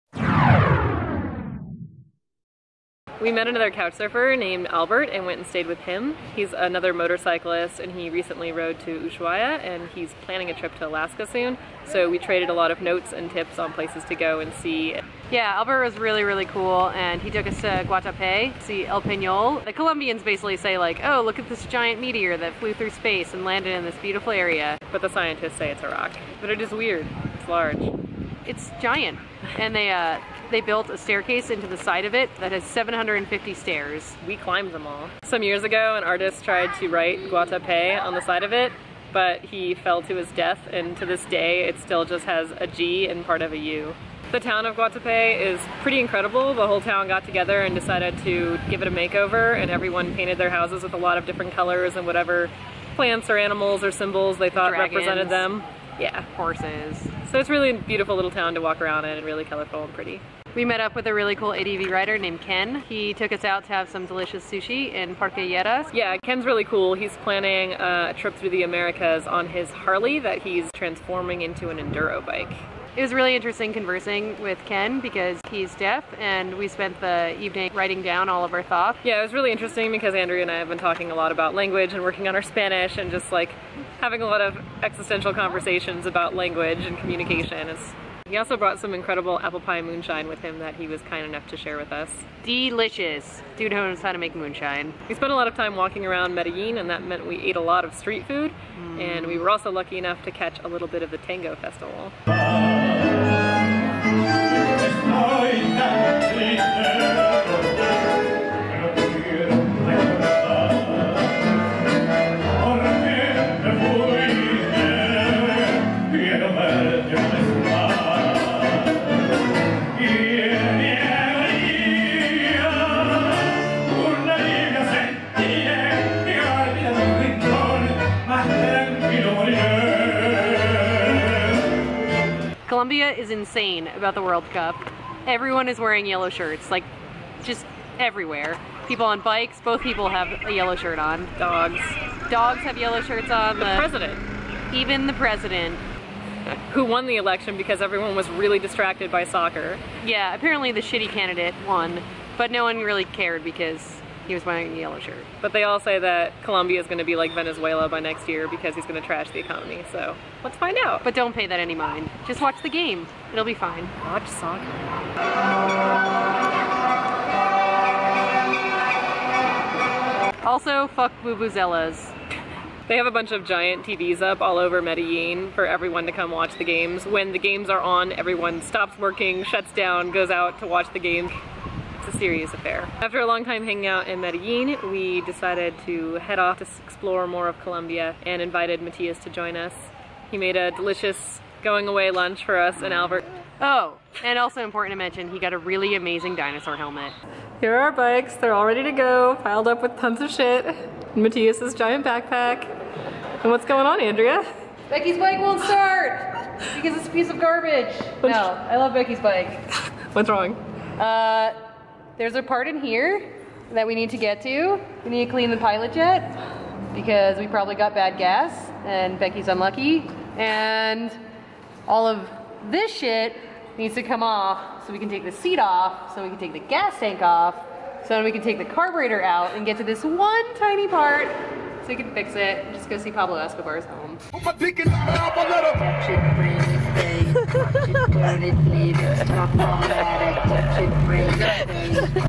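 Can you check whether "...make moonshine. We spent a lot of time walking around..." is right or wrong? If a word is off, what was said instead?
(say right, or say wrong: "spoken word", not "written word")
right.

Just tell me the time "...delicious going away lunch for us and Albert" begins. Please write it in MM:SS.
03:10.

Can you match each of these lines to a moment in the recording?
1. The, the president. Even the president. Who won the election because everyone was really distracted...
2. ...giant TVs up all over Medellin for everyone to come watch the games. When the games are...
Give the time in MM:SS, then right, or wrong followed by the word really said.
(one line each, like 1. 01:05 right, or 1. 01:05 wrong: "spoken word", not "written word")
1. 02:23 right
2. 02:53 right.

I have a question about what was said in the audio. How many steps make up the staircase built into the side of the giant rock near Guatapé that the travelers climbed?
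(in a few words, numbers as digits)
750.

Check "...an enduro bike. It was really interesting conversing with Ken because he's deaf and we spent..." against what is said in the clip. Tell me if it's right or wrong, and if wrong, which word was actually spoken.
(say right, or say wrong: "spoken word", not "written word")
right.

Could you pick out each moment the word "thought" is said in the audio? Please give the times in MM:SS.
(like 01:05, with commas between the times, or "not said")
00:54, 01:18.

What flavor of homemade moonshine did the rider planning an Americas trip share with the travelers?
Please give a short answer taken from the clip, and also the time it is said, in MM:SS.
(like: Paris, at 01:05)
Apple pie, at 01:29.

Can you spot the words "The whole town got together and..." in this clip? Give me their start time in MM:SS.
00:46.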